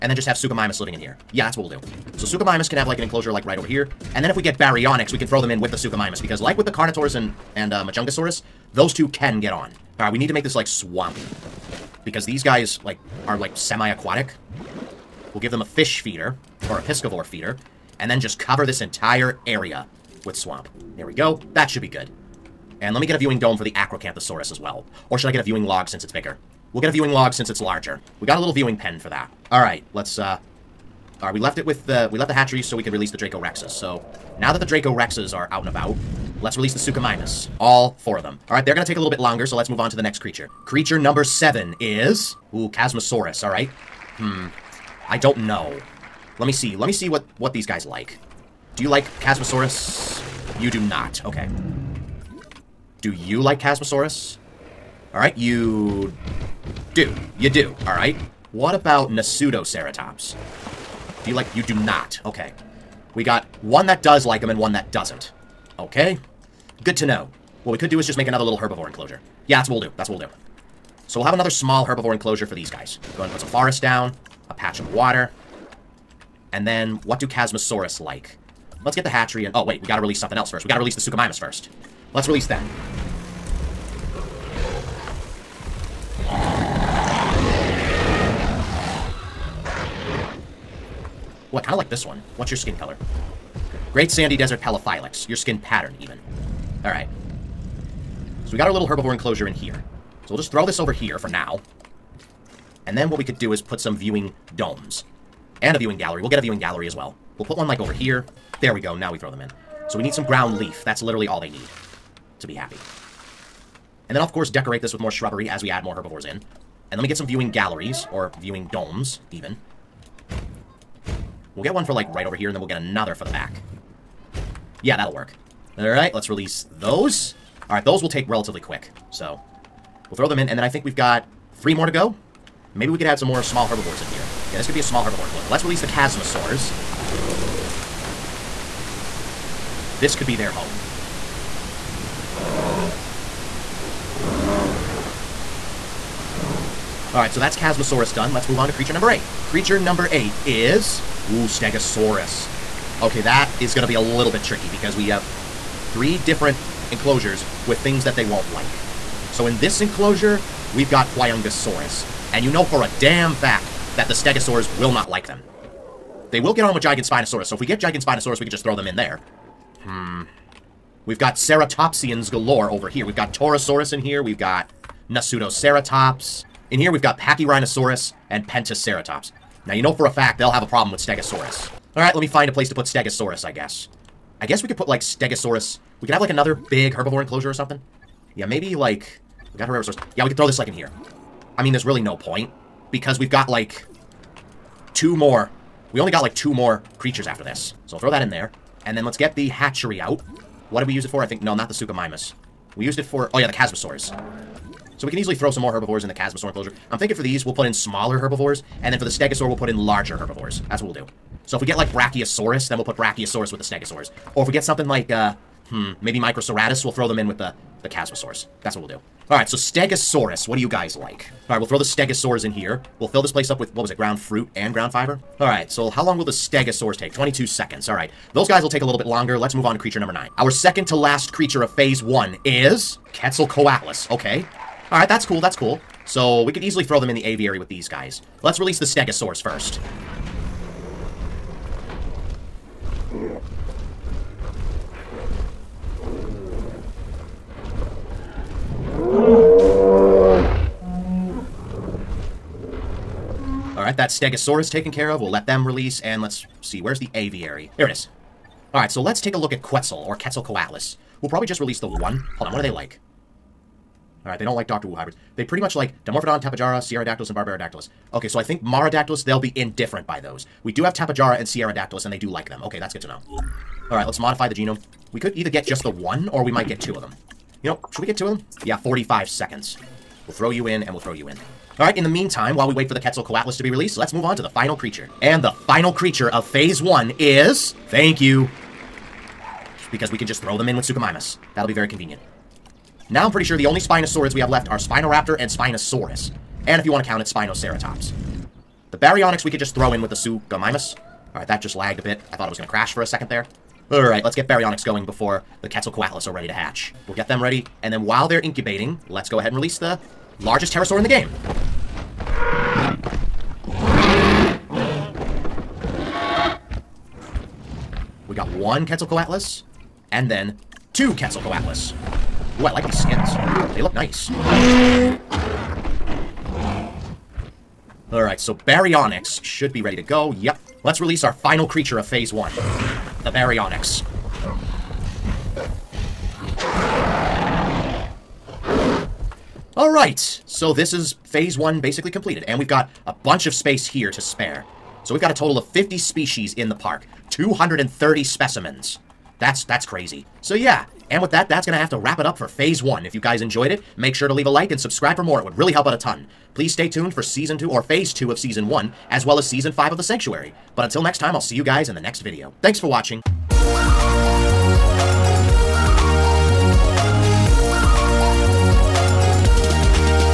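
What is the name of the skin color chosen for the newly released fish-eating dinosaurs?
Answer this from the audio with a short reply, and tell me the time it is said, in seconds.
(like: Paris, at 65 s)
Great Sandy Desert Pelophylax, at 93 s.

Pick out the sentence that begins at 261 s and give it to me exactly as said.
We'll probably just release the one.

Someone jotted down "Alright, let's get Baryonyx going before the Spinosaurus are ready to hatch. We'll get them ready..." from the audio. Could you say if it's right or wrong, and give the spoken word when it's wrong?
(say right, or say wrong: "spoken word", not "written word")
wrong: "Quetzalcoatlus", not "Spinosaurus".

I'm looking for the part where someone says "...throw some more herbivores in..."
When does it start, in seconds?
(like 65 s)
205 s.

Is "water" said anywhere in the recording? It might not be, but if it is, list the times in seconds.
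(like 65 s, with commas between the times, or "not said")
74 s.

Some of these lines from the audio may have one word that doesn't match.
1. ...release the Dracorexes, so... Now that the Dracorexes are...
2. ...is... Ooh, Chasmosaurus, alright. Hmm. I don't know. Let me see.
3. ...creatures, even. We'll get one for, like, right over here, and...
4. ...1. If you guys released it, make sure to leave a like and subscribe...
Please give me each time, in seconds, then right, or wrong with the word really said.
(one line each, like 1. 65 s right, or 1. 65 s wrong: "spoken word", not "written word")
1. 32 s right
2. 41 s right
3. 118 s wrong: "domes", not "creatures"
4. 352 s wrong: "enjoyed", not "released".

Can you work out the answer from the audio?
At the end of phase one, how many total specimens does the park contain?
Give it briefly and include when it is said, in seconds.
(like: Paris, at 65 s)
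230, at 347 s.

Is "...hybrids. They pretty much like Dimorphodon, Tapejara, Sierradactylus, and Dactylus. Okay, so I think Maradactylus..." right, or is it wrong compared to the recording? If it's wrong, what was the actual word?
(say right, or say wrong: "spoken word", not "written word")
right.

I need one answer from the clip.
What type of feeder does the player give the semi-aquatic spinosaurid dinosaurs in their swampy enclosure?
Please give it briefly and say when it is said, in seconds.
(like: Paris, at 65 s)
piscivore feeder, at 16 s.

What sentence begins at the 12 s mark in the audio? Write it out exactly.
Because these guys like are like semi-aquatic.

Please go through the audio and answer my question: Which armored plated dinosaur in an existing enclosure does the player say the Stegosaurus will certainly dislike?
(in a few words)
Huayangosaurus.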